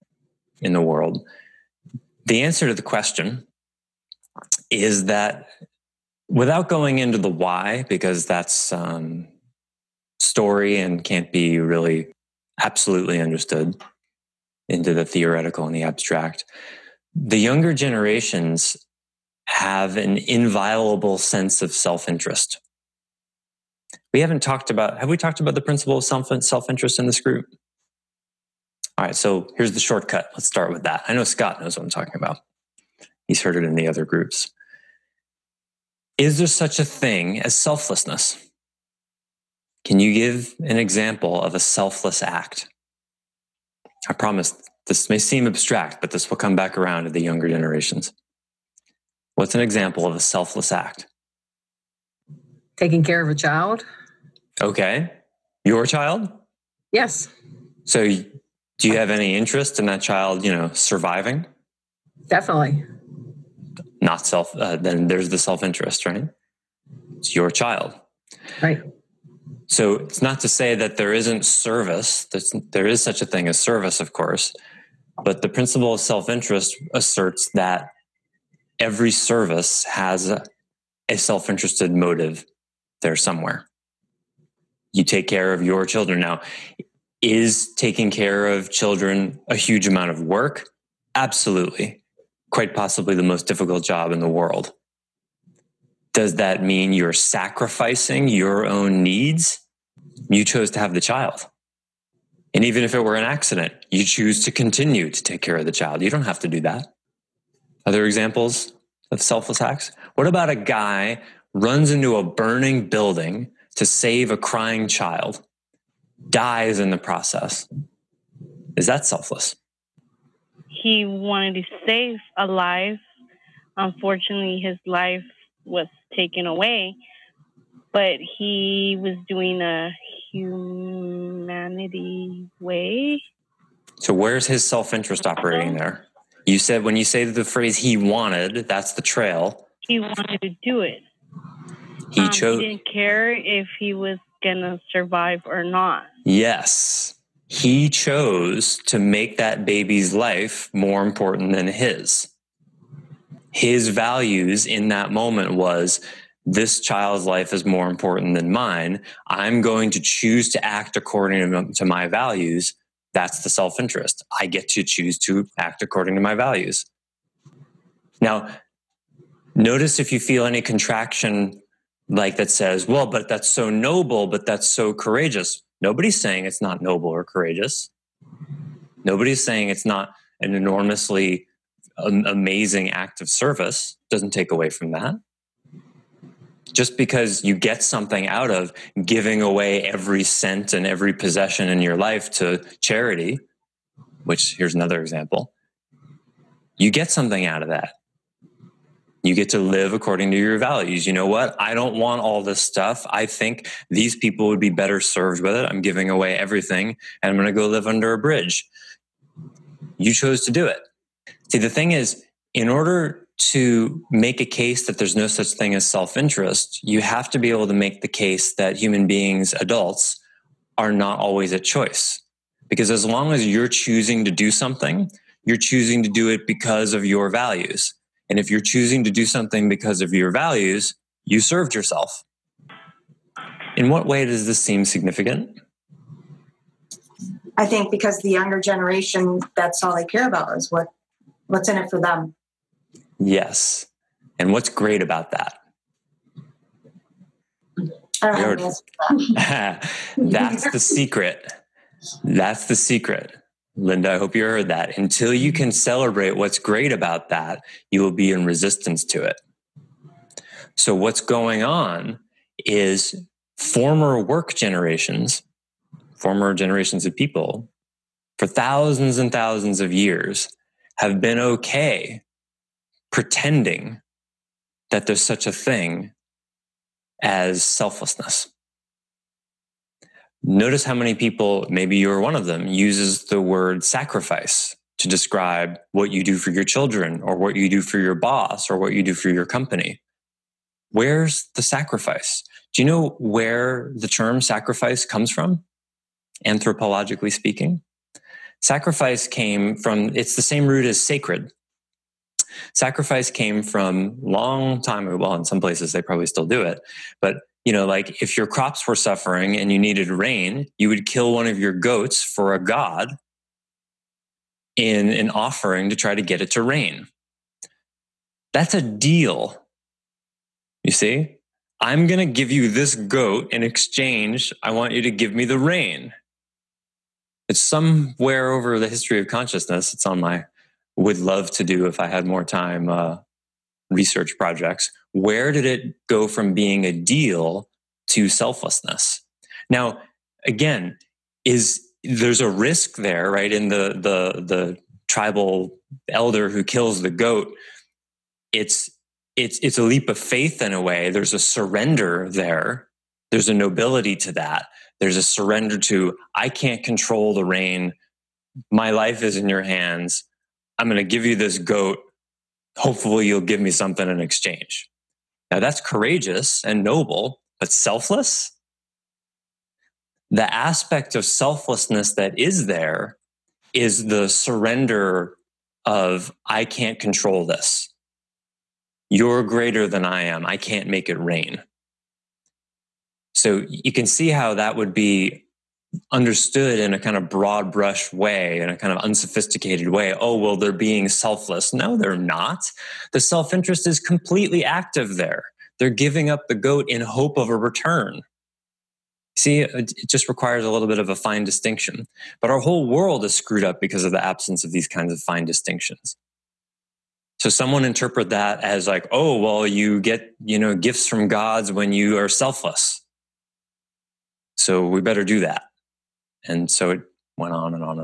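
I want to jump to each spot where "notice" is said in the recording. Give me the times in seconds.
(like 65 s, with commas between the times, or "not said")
169 s, 280 s.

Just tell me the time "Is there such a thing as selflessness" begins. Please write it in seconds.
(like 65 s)
36 s.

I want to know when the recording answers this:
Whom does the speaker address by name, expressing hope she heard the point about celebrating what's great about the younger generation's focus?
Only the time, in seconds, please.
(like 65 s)
253 s.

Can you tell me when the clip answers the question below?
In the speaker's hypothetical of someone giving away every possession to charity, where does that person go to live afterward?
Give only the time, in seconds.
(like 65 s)
207 s.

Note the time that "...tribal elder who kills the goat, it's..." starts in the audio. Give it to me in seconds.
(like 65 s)
345 s.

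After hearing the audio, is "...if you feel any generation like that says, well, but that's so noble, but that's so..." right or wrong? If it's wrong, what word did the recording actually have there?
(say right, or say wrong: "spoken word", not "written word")
wrong: "contraction", not "generation".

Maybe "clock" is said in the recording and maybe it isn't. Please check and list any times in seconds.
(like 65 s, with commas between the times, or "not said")
not said.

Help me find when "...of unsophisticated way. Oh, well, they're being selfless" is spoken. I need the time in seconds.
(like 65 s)
388 s.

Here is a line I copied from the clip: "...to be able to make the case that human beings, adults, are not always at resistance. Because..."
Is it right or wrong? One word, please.
wrong.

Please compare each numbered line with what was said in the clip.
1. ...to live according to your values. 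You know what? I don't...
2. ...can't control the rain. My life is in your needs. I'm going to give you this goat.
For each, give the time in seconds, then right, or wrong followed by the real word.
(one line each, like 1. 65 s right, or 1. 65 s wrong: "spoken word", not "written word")
1. 199 s right
2. 356 s wrong: "hands", not "needs".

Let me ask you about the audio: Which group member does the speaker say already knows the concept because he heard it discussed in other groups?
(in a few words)
Scott.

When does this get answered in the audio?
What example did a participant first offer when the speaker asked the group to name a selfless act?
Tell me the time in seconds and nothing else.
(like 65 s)
52 s.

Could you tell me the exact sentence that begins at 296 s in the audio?
Anthropologically speaking, sacrifice came from, it's the same root as sacred.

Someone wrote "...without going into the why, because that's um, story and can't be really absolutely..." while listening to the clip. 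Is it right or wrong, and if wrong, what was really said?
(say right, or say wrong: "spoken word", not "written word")
right.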